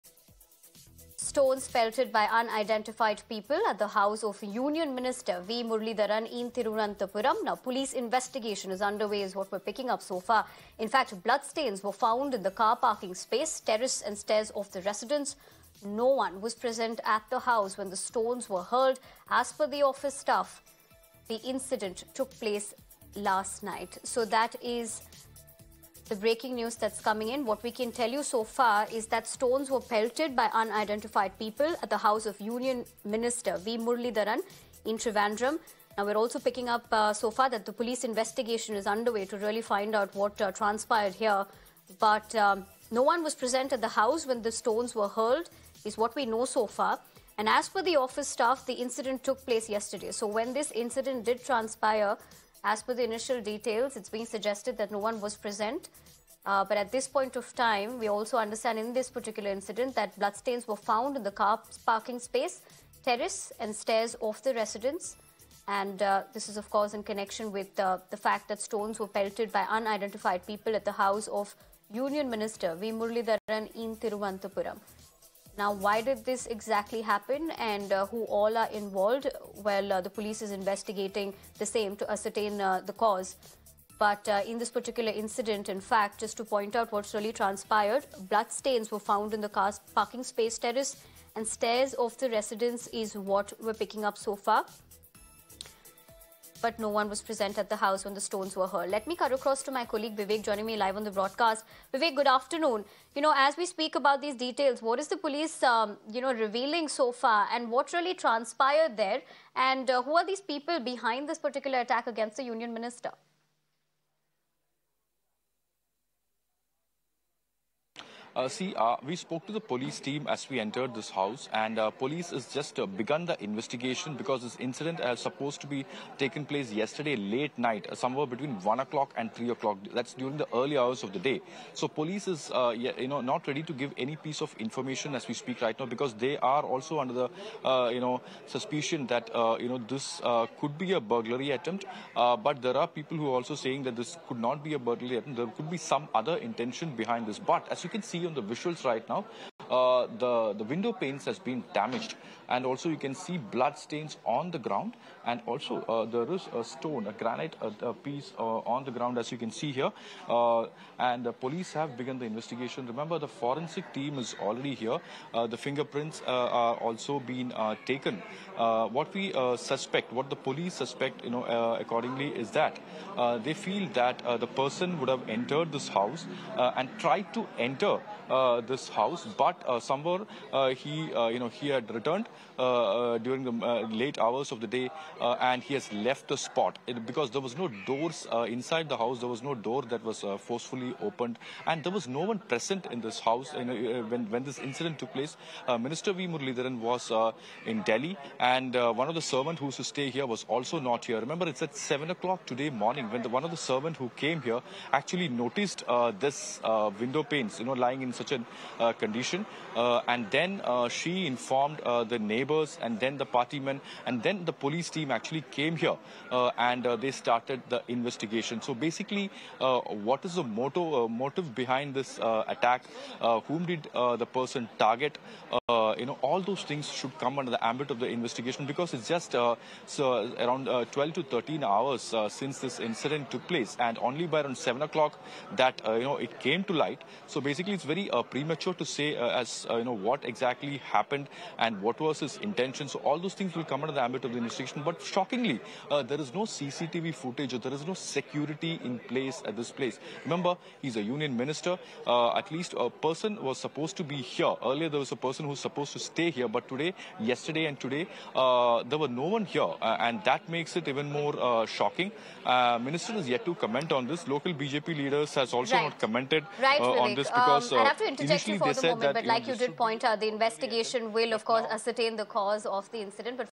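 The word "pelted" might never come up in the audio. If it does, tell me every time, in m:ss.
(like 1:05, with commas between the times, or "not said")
0:01, 0:29, 1:09.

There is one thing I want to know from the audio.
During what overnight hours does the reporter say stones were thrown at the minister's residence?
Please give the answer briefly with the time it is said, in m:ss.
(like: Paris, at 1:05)
Between 1 and 3 o'clock, at 2:08.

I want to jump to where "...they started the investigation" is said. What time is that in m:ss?
3:37.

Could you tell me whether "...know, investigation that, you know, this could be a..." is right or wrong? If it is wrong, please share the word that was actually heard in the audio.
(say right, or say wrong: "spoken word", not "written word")
wrong: "suspicion", not "investigation".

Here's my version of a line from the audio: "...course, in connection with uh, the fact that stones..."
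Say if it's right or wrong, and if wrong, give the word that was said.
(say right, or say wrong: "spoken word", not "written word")
right.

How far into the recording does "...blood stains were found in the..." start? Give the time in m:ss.
1:28.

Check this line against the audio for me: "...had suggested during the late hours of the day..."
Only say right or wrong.
wrong.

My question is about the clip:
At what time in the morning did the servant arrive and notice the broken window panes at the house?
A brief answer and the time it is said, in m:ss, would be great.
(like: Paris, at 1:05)
7 o'clock, at 3:21.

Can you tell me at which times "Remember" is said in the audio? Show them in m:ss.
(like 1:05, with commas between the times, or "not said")
2:42, 3:21, 4:10.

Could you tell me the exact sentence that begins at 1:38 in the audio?
Let me cut across to my colleague Vivek joining me live on the broadcast.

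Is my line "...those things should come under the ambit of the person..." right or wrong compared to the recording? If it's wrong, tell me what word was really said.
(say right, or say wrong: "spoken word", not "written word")
wrong: "investigation", not "person".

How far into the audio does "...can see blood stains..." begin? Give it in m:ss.
2:32.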